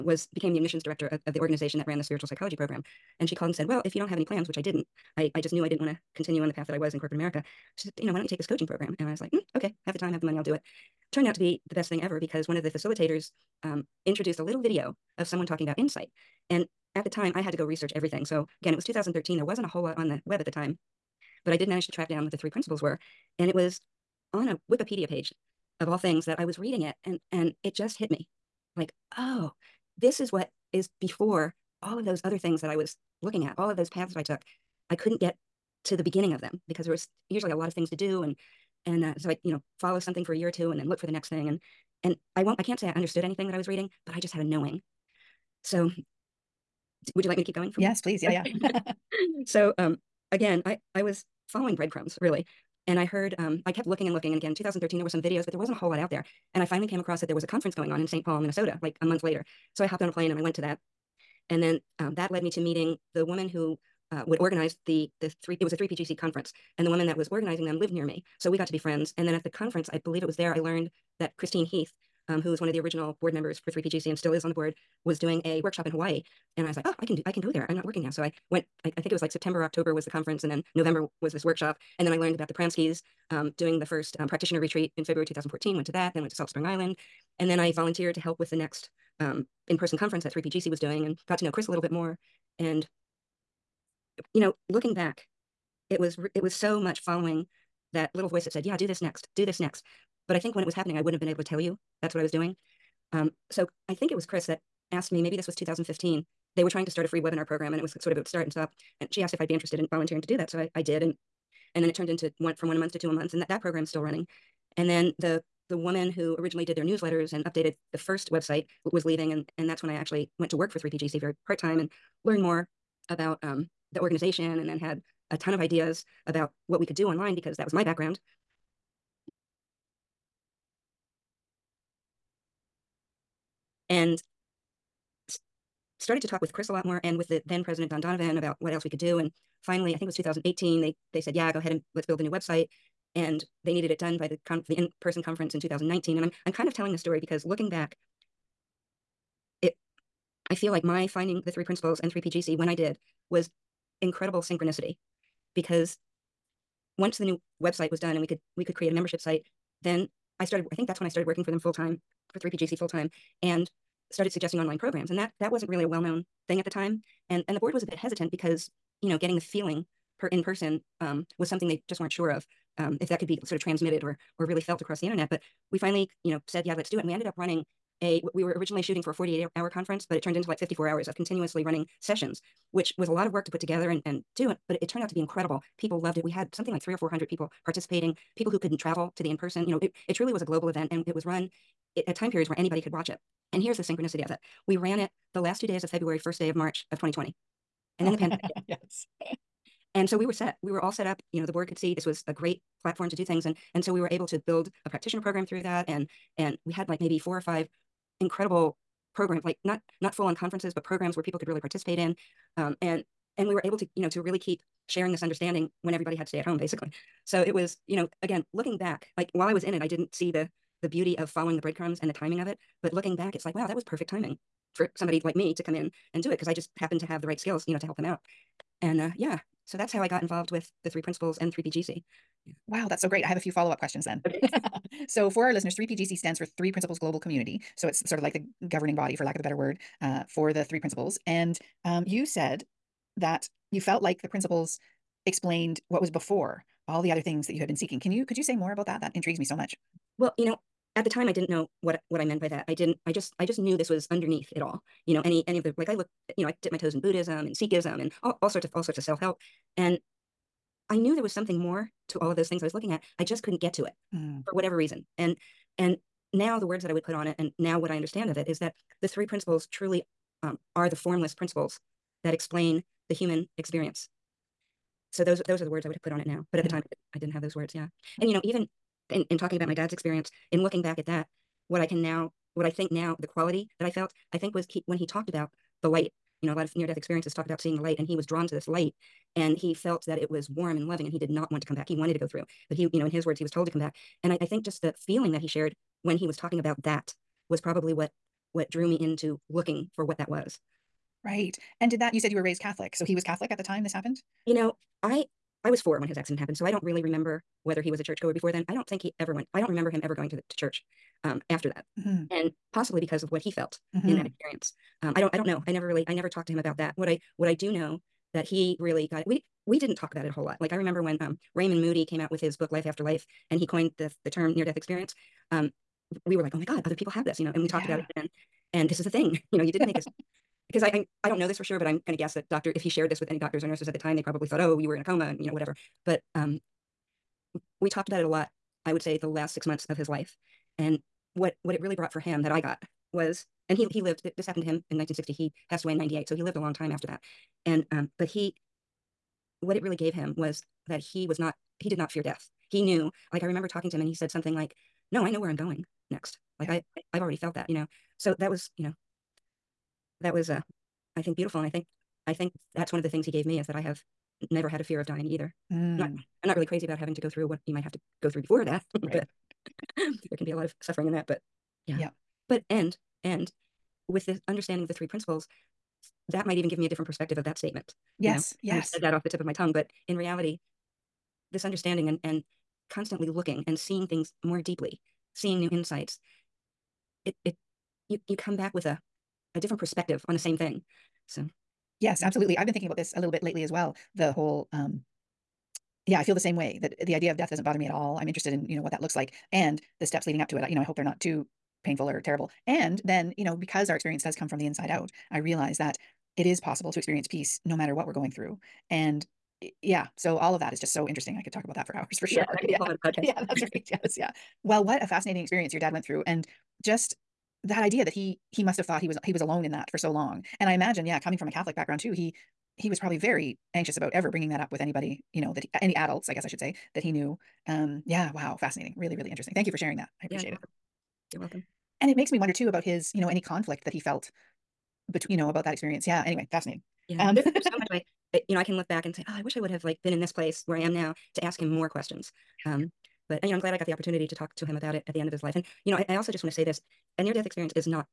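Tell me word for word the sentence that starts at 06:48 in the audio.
And yeah, so all of that is just so interesting.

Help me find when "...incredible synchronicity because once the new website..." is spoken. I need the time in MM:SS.
02:34.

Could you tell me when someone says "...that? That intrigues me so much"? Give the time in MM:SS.
04:08.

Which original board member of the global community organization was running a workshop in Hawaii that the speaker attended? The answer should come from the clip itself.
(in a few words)
Christine Heath.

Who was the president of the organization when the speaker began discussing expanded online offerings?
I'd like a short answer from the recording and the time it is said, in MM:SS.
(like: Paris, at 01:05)
Don Donovan, at 02:17.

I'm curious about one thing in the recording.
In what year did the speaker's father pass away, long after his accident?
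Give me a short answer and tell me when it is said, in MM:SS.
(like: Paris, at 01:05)
1998, at 05:45.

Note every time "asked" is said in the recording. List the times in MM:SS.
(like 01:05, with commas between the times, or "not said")
01:44, 01:49.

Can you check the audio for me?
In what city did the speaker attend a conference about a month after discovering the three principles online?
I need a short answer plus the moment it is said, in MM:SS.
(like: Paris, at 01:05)
St. Paul, Minnesota, at 00:58.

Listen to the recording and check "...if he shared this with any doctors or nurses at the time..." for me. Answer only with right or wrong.
right.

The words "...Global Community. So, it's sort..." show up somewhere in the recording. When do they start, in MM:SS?
03:56.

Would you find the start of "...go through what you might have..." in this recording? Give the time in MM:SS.
06:07.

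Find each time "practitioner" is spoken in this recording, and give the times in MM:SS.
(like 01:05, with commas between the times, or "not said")
01:24, 03:24.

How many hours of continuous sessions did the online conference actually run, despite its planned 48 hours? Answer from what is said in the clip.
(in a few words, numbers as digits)
54.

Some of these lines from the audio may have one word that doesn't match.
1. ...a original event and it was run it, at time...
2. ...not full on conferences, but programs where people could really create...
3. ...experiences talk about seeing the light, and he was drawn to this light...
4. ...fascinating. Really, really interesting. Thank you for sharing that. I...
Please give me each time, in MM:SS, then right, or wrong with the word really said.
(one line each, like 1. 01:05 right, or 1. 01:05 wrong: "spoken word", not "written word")
1. 03:10 wrong: "global", not "original"
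2. 03:30 wrong: "participate", not "create"
3. 04:46 right
4. 07:08 right.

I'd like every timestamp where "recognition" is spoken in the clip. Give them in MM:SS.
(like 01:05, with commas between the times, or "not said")
not said.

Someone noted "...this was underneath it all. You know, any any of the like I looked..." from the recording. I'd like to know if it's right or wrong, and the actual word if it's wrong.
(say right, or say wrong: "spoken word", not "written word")
right.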